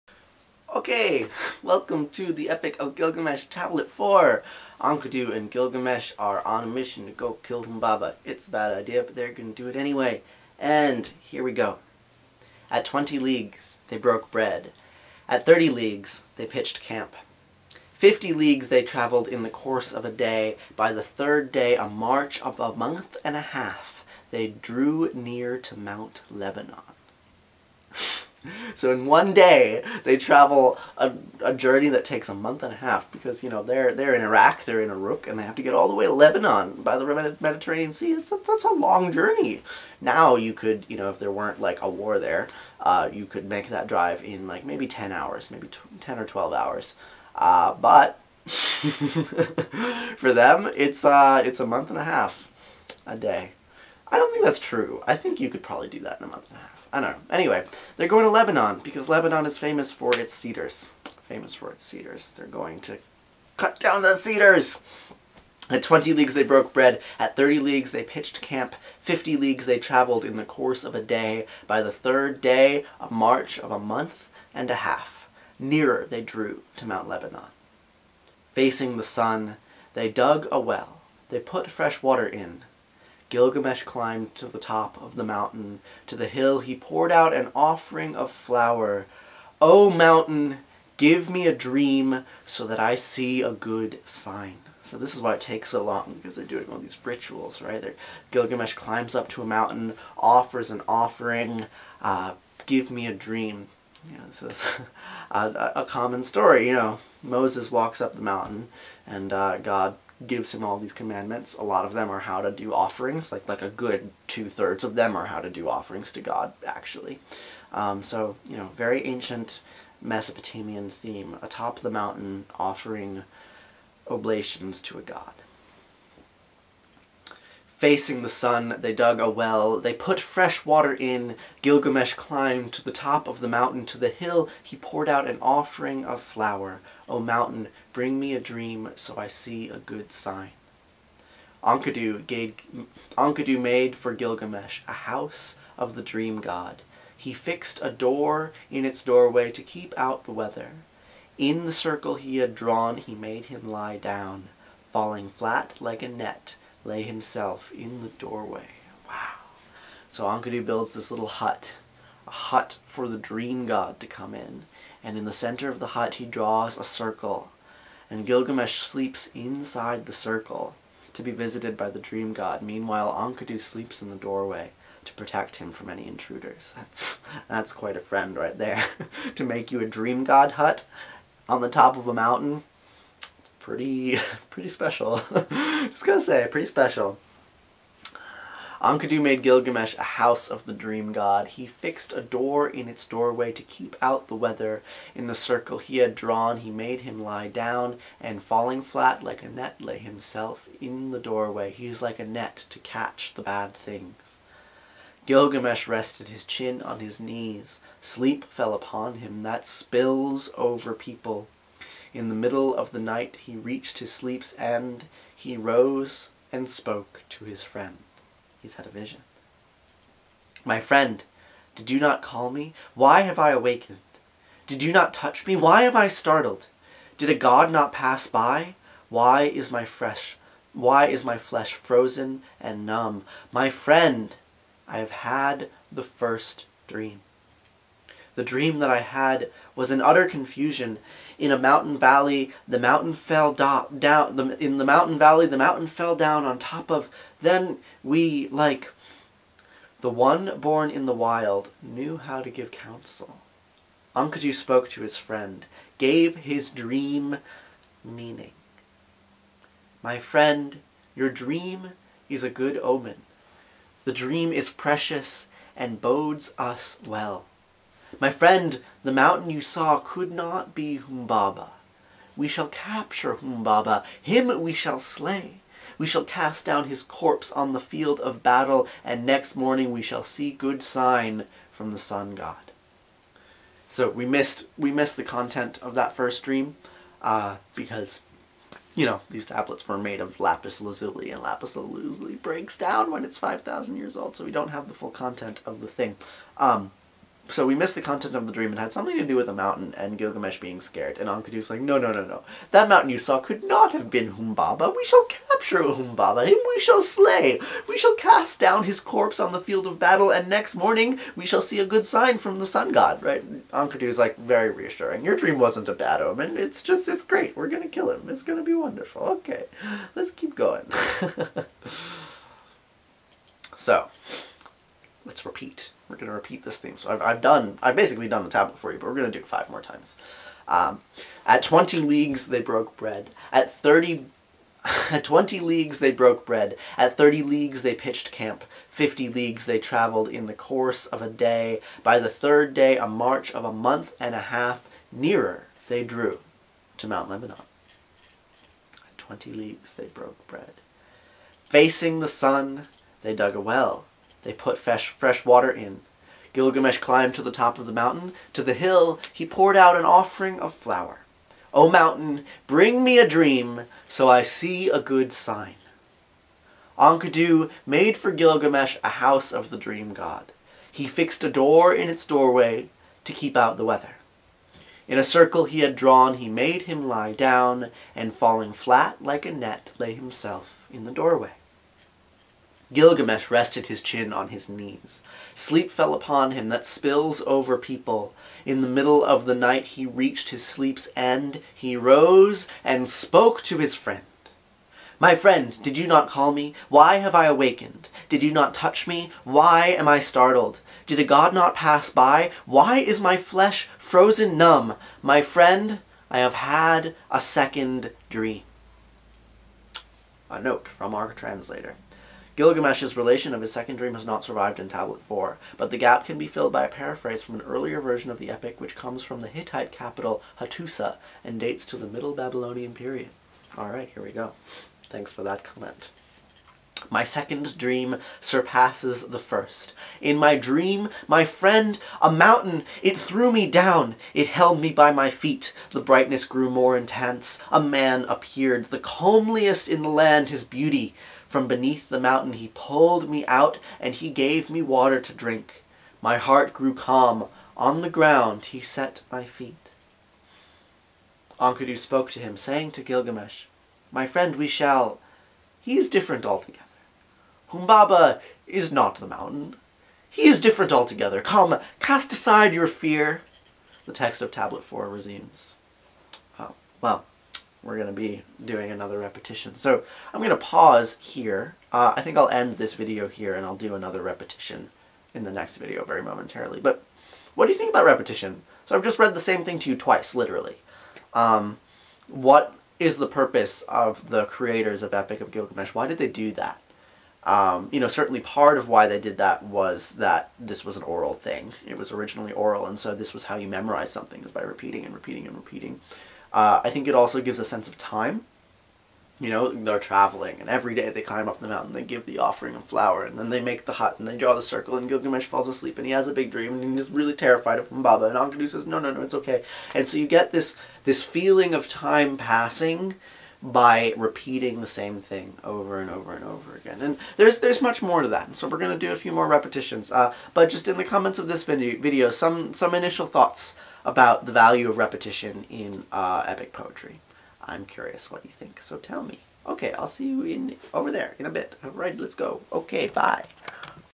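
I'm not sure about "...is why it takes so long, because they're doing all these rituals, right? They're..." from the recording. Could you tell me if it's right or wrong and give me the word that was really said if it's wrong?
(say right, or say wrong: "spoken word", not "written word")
right.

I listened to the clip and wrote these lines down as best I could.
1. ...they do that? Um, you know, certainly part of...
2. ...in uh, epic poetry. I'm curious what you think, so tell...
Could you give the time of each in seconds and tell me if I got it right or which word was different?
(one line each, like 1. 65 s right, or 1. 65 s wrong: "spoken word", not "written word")
1. 486 s right
2. 525 s right.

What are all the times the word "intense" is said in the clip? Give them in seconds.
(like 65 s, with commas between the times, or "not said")
436 s.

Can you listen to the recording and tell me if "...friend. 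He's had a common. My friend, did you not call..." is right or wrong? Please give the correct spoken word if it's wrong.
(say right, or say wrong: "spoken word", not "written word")
wrong: "vision", not "common".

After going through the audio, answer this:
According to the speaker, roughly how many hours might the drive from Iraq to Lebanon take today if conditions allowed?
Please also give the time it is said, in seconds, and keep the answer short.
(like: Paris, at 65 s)
10 to 12 hours, at 45 s.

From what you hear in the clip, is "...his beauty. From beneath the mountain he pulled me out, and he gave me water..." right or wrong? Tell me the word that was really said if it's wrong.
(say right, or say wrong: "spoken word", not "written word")
right.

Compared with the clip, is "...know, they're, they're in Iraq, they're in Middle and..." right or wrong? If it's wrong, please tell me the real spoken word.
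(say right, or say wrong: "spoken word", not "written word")
wrong: "Iraq", not "Middle".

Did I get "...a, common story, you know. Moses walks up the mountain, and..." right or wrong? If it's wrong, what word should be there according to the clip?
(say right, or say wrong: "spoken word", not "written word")
right.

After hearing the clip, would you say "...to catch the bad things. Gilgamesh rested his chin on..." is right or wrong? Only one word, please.
right.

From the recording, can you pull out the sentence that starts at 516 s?
And there's there's much more to that, and so we're going to do a few more repetitions.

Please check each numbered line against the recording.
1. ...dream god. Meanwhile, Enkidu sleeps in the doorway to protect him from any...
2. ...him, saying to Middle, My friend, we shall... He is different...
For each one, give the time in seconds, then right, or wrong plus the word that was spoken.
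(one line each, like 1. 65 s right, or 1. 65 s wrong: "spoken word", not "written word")
1. 171 s right
2. 452 s wrong: "Gilgamesh", not "Middle".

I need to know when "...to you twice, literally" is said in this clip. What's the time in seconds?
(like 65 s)
479 s.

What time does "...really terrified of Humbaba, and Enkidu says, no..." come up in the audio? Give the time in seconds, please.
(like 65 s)
507 s.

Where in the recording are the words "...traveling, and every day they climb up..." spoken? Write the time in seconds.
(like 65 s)
499 s.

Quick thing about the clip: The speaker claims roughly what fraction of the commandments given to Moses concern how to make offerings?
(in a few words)
two thirds.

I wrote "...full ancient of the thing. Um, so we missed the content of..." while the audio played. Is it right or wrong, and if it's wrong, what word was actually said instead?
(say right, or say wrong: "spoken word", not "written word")
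wrong: "content", not "ancient".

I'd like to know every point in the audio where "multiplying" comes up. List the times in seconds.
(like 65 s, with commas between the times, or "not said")
not said.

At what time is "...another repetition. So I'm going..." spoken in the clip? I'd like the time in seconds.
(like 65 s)
468 s.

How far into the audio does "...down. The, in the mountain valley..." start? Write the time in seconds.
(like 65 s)
243 s.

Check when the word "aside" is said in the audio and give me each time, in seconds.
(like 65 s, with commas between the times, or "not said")
462 s.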